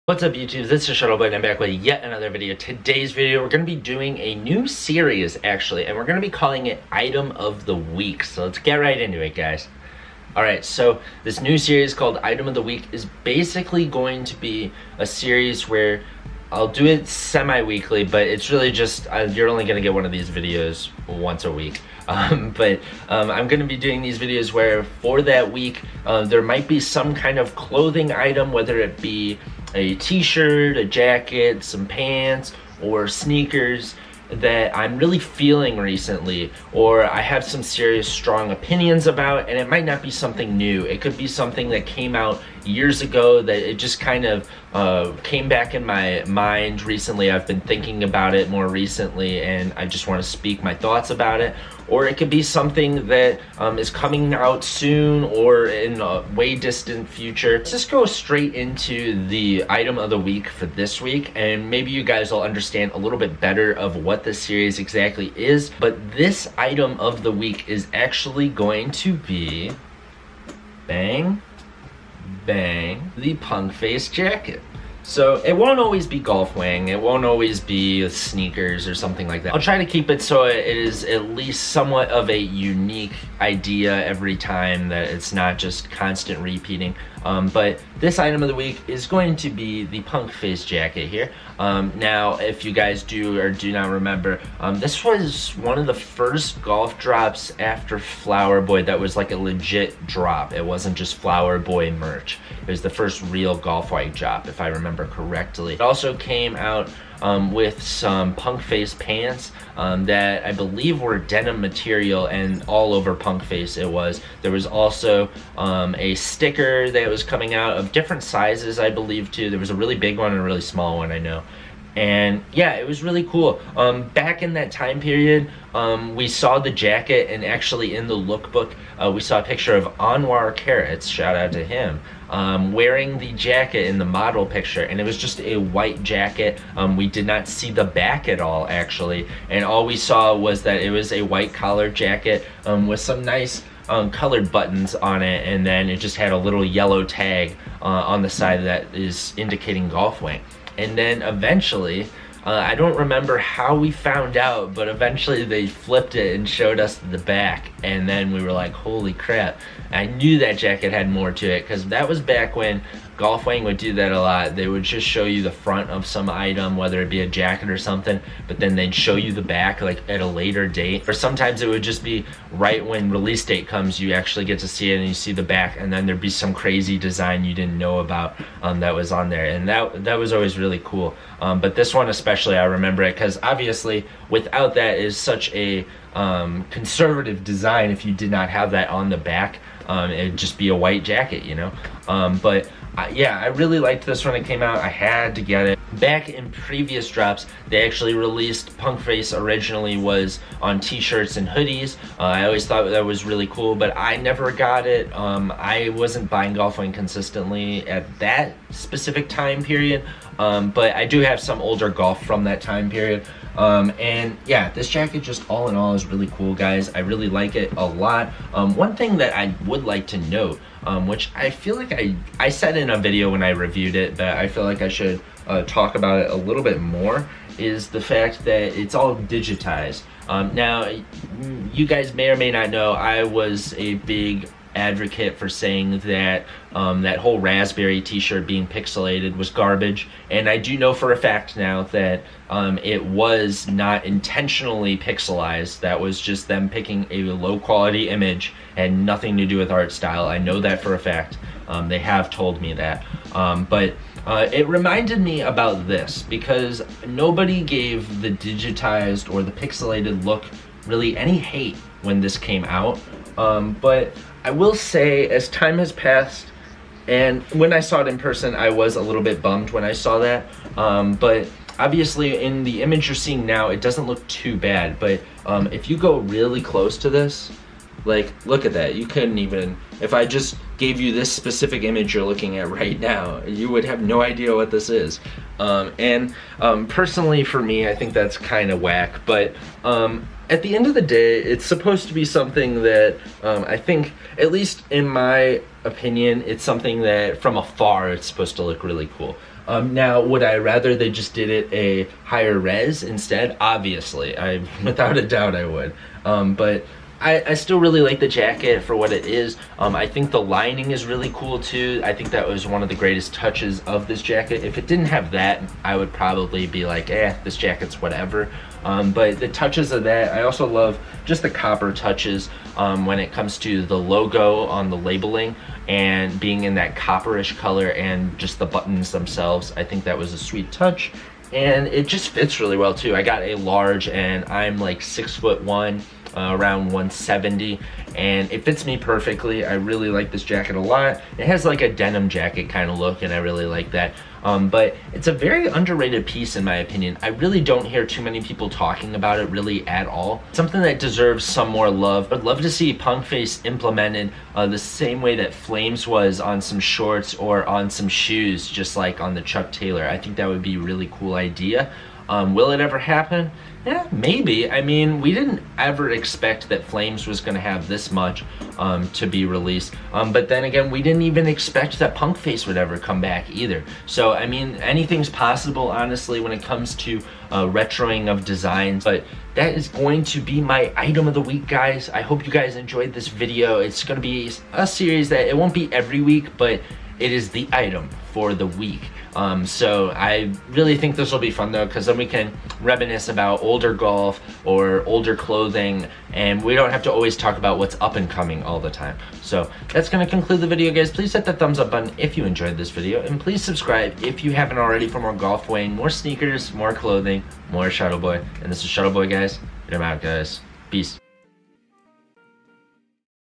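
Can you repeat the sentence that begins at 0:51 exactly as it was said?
Or it could be something that um, is coming out soon or in a way distant future.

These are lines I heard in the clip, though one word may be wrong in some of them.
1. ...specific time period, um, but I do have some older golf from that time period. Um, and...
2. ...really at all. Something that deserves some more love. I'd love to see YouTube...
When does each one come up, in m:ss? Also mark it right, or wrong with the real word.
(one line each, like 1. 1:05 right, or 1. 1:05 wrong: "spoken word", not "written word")
1. 3:28 right
2. 5:49 wrong: "Punk", not "YouTube".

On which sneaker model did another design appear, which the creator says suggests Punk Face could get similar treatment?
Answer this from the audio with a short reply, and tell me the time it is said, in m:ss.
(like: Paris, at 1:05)
Chuck Taylor, at 5:59.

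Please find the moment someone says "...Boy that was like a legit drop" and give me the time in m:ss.
1:38.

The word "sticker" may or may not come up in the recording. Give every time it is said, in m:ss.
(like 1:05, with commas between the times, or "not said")
1:56.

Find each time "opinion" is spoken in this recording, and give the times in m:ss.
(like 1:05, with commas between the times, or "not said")
0:38, 4:55, 5:46.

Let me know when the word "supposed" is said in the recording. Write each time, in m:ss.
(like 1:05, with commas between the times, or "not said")
4:51, 4:58.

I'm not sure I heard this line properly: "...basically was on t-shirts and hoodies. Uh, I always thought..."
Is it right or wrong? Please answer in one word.
wrong.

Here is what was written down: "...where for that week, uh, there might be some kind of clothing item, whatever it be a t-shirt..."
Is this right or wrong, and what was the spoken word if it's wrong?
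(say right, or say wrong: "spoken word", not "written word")
wrong: "whether", not "whatever".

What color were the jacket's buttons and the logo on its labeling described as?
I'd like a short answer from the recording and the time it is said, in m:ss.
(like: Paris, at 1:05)
Copper, at 5:26.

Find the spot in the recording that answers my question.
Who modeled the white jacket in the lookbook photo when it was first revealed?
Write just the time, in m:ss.
2:09.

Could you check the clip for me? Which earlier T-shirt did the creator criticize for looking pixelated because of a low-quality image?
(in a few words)
Raspberry T-shirt.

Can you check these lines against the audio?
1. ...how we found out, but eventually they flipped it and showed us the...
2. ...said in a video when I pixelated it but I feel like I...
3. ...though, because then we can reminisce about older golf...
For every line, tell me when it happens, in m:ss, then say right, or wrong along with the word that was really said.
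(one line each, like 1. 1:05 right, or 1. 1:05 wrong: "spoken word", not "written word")
1. 2:33 right
2. 3:42 wrong: "reviewed", not "pixelated"
3. 6:31 right.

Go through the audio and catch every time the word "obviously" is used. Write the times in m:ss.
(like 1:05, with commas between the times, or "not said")
3:03, 4:31, 5:03.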